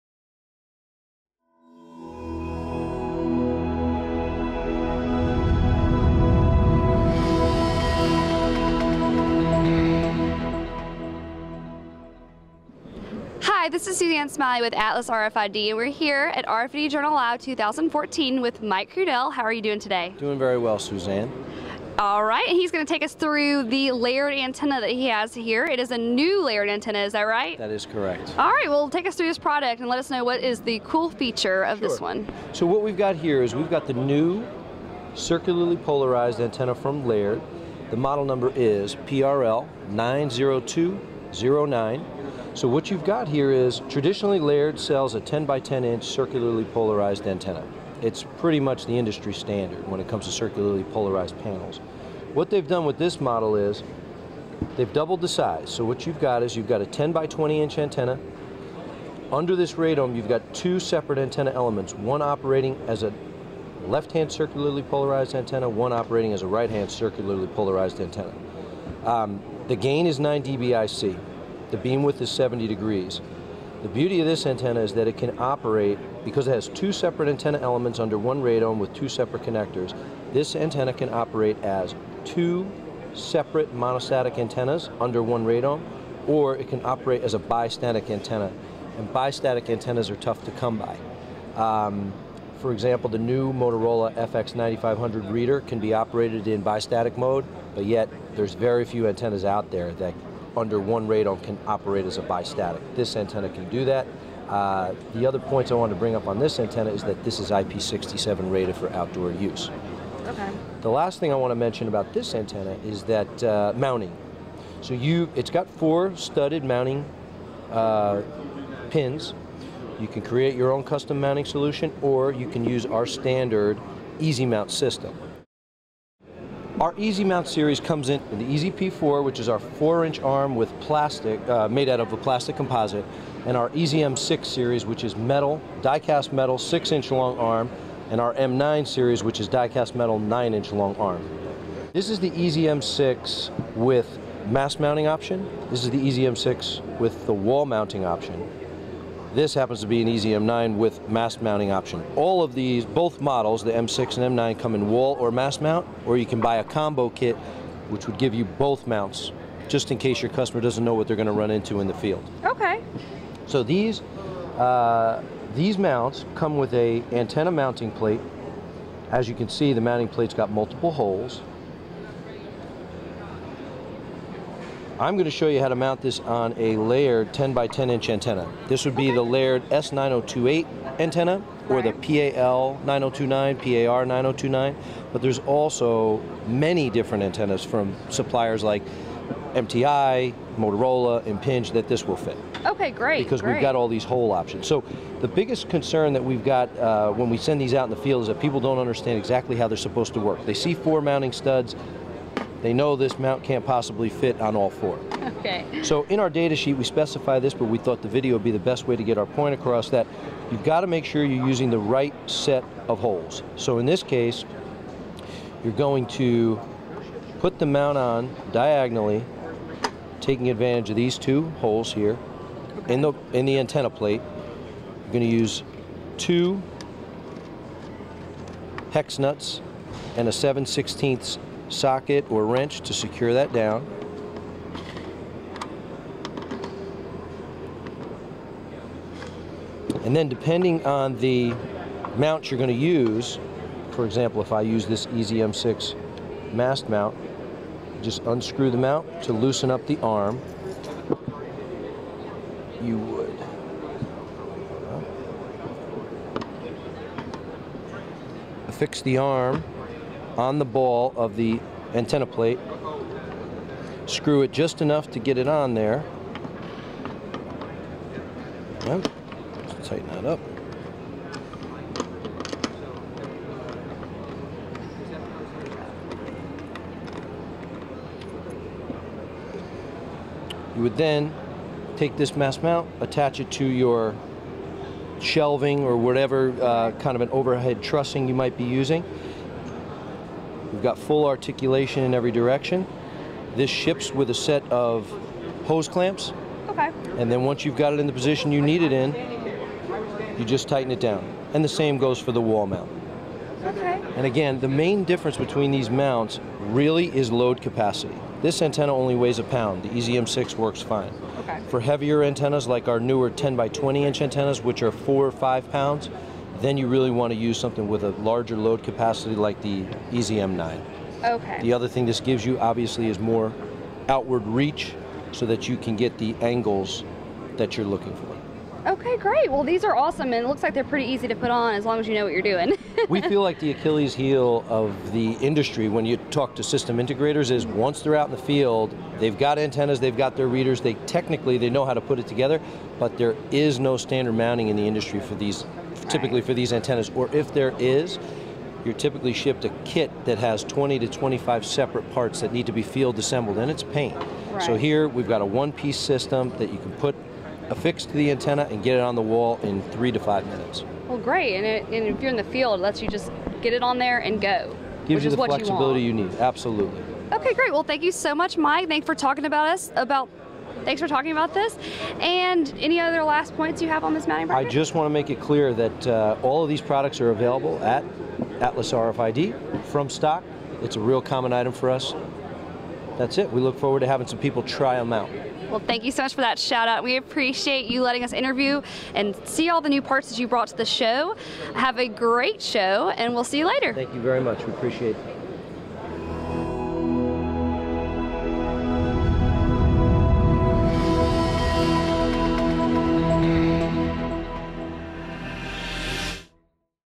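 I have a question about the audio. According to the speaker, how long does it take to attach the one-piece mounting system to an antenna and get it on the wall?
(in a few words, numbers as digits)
3 to 5 minutes.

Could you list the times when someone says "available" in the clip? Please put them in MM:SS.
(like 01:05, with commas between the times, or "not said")
06:17.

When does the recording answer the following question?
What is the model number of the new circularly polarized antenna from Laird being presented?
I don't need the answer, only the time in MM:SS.
00:38.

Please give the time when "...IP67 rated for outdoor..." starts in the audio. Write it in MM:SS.
01:47.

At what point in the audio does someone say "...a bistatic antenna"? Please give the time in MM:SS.
01:27.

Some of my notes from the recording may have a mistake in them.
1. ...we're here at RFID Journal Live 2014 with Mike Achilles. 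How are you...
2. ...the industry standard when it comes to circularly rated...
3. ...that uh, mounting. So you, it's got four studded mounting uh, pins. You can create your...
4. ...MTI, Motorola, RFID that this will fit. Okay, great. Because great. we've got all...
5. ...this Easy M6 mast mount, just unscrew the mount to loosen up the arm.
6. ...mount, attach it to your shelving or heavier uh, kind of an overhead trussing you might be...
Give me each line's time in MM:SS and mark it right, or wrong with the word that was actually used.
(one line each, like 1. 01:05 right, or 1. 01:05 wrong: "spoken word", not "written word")
1. 00:15 wrong: "Crudele", not "Achilles"
2. 00:48 wrong: "polarized", not "rated"
3. 01:53 right
4. 03:09 wrong: "Impinj", not "RFID"
5. 04:04 right
6. 04:42 wrong: "whatever", not "heavier".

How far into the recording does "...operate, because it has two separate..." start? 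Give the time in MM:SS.
01:15.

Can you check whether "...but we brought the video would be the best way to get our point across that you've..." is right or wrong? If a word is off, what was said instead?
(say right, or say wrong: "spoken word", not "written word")
wrong: "thought", not "brought".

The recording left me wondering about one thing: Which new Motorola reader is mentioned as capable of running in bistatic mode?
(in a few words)
FX9500.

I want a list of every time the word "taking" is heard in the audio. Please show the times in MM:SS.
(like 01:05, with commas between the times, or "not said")
03:40.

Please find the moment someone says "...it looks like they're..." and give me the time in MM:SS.
05:30.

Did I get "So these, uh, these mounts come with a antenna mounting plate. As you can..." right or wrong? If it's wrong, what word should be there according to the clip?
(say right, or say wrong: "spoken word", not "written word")
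right.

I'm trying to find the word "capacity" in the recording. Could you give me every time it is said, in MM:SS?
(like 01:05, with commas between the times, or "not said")
05:07, 05:18.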